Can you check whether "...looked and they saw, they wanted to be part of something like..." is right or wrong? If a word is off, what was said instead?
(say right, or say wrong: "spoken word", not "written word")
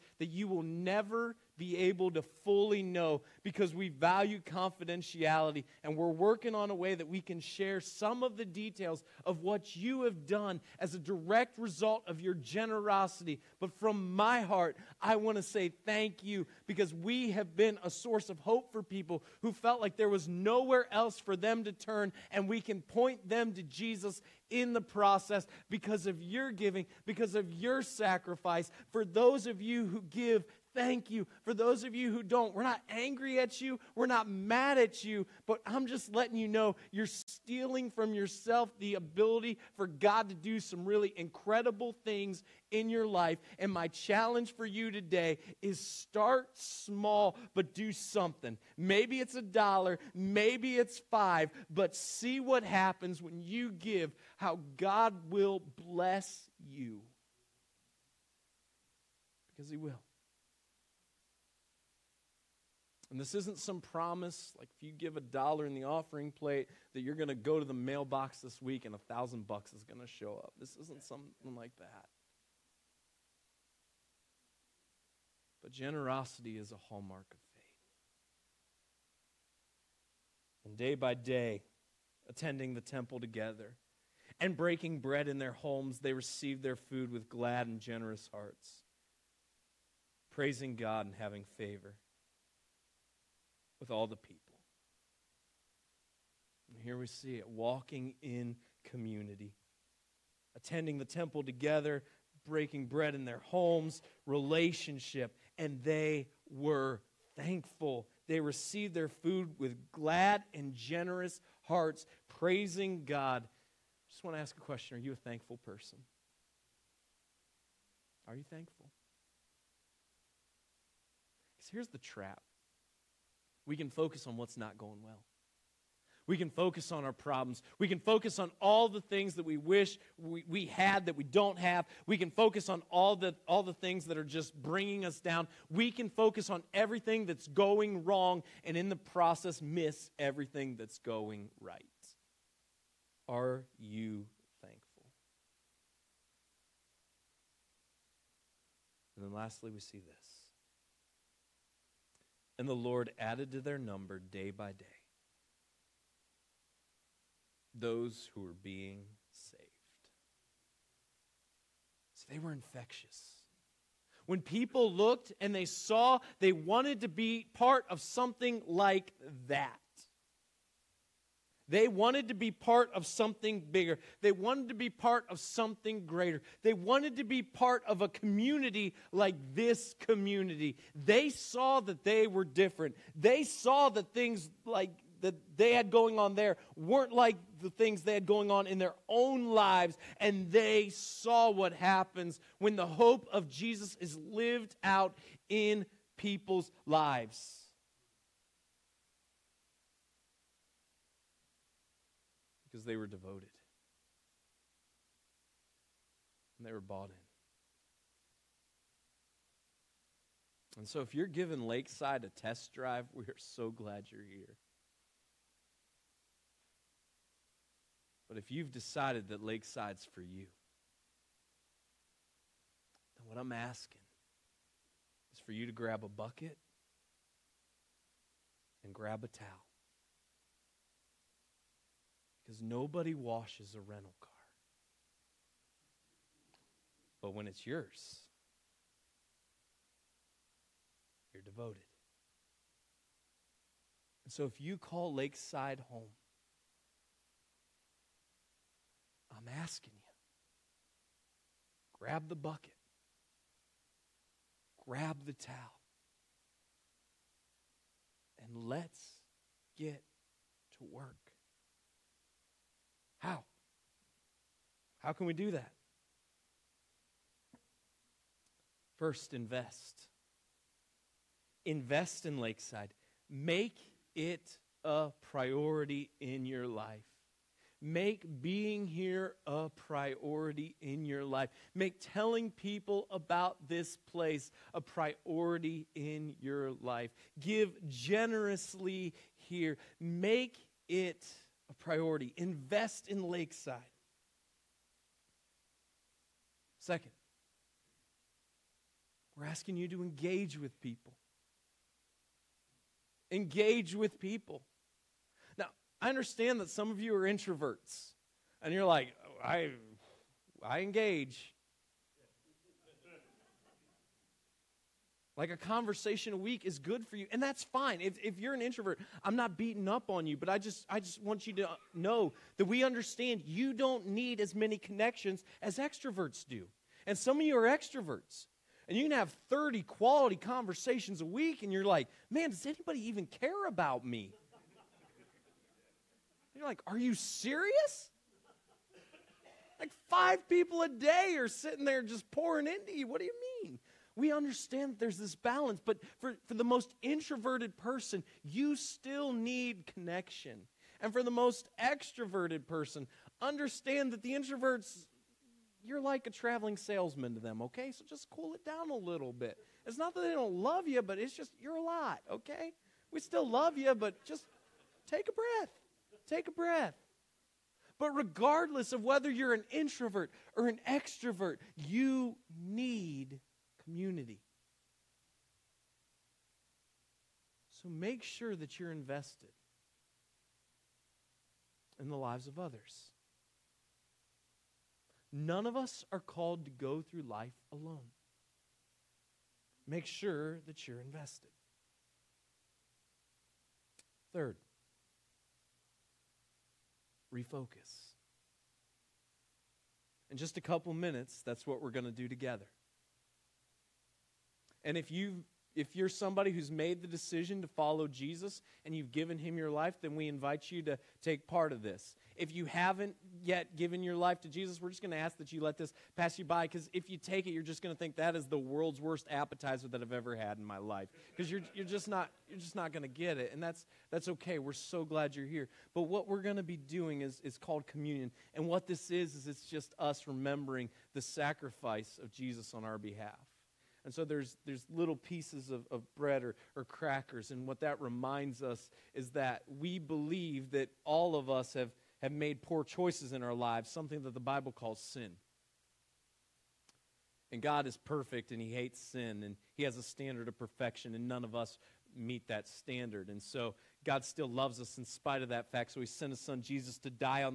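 right.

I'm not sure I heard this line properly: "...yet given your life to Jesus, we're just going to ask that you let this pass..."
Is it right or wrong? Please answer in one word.
right.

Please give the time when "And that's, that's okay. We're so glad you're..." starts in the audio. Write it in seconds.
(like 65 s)
423 s.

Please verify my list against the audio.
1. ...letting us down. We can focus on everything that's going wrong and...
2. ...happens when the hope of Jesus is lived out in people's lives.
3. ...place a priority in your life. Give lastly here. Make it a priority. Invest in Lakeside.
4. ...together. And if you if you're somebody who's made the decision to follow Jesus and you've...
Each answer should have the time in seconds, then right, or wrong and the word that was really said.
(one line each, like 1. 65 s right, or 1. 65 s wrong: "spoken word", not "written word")
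1. 134 s wrong: "bringing", not "letting"
2. 191 s right
3. 284 s wrong: "generously", not "lastly"
4. 402 s right.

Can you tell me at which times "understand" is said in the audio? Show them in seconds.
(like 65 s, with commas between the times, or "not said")
306 s, 322 s, 344 s, 353 s.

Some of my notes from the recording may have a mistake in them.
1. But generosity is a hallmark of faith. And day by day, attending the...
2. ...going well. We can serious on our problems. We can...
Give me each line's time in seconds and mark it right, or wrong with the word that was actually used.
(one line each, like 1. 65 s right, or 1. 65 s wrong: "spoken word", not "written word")
1. 75 s right
2. 124 s wrong: "focus", not "serious".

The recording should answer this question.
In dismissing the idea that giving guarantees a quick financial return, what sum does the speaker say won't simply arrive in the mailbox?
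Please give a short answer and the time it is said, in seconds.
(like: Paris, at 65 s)
1000 bucks, at 68 s.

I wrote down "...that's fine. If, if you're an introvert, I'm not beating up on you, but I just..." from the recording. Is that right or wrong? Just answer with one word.
right.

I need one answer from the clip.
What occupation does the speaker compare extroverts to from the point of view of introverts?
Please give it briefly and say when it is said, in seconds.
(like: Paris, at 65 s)
Traveling salesman, at 356 s.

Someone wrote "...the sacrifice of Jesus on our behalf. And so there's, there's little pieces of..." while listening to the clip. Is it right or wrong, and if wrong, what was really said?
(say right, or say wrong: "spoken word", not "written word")
right.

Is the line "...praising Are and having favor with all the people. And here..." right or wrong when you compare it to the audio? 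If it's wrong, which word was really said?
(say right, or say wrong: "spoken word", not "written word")
wrong: "God", not "Are".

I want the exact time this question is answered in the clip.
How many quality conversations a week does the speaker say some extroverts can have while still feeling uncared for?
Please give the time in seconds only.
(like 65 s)
329 s.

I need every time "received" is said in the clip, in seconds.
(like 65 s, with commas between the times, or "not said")
86 s, 108 s.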